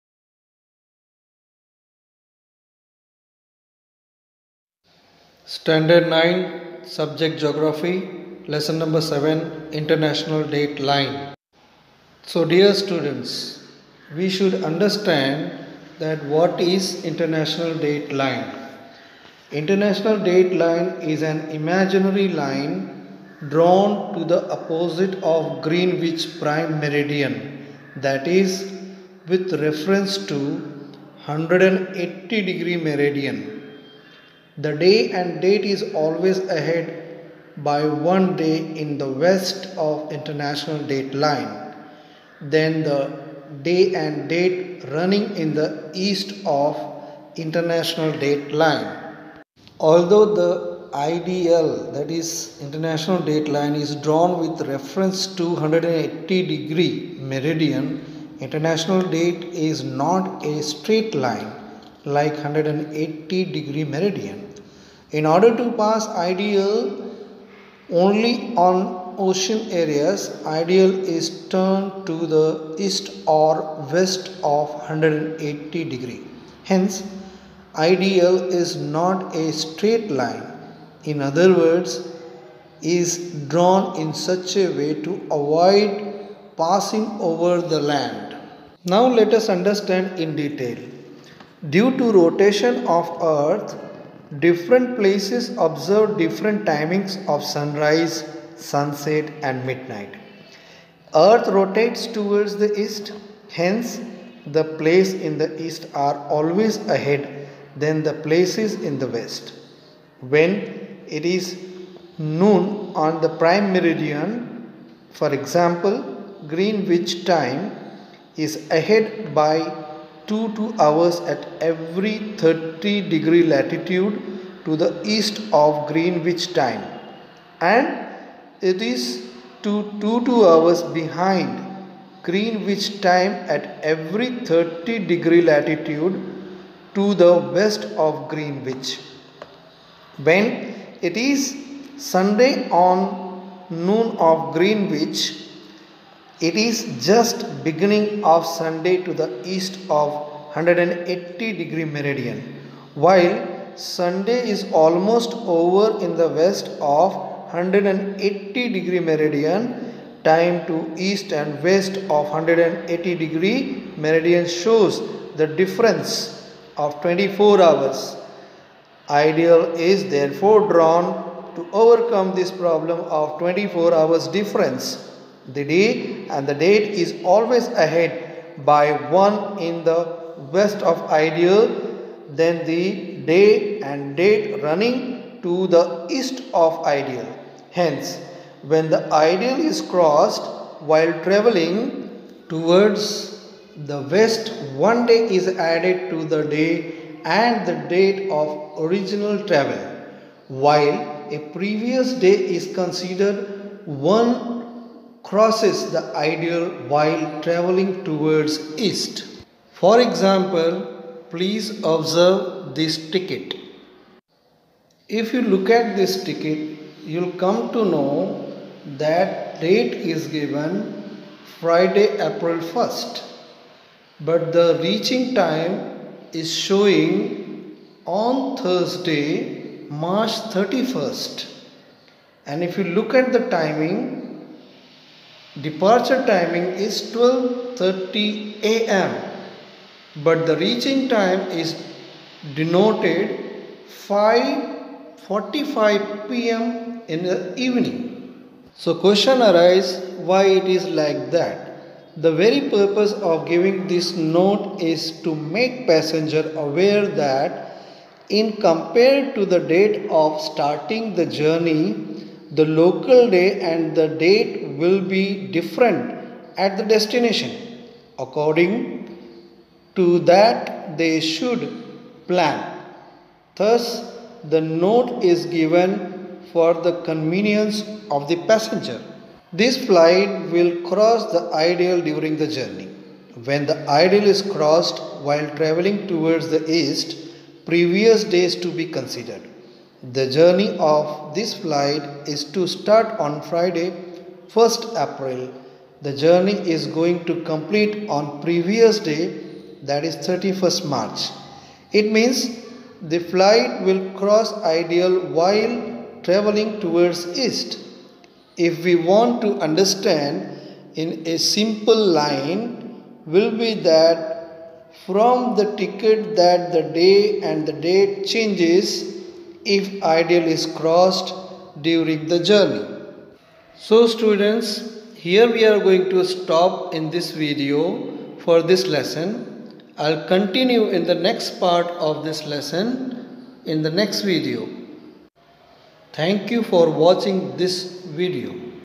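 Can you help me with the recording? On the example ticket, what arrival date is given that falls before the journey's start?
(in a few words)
March 31st.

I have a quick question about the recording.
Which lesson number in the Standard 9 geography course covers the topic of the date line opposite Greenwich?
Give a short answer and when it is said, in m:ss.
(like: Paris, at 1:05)
7, at 0:09.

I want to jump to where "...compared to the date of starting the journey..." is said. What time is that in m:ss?
4:18.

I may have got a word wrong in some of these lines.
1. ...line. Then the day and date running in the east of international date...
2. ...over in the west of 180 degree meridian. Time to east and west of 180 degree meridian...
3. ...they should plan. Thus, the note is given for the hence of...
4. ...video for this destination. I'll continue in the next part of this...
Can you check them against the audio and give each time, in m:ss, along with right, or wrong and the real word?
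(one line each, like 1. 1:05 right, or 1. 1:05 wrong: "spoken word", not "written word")
1. 0:41 right
2. 2:35 right
3. 4:31 wrong: "convenience", not "hence"
4. 5:27 wrong: "lesson", not "destination".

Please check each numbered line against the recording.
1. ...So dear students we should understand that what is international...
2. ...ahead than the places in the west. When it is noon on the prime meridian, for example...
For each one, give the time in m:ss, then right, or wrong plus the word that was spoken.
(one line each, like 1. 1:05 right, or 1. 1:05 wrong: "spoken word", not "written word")
1. 0:12 right
2. 1:46 right.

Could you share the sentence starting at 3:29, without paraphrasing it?
For example, please observe this ticket.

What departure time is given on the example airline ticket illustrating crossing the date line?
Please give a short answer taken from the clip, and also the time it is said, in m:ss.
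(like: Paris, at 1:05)
12:30 a.m., at 3:57.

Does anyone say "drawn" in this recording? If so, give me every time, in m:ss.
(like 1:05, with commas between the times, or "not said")
0:23, 0:53, 1:23, 2:50.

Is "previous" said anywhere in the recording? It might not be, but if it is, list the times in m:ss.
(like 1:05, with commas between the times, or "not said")
3:21, 4:47, 4:58.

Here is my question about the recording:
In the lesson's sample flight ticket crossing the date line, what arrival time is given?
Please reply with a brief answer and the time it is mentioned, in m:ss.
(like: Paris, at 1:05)
5:45 p.m., at 4:03.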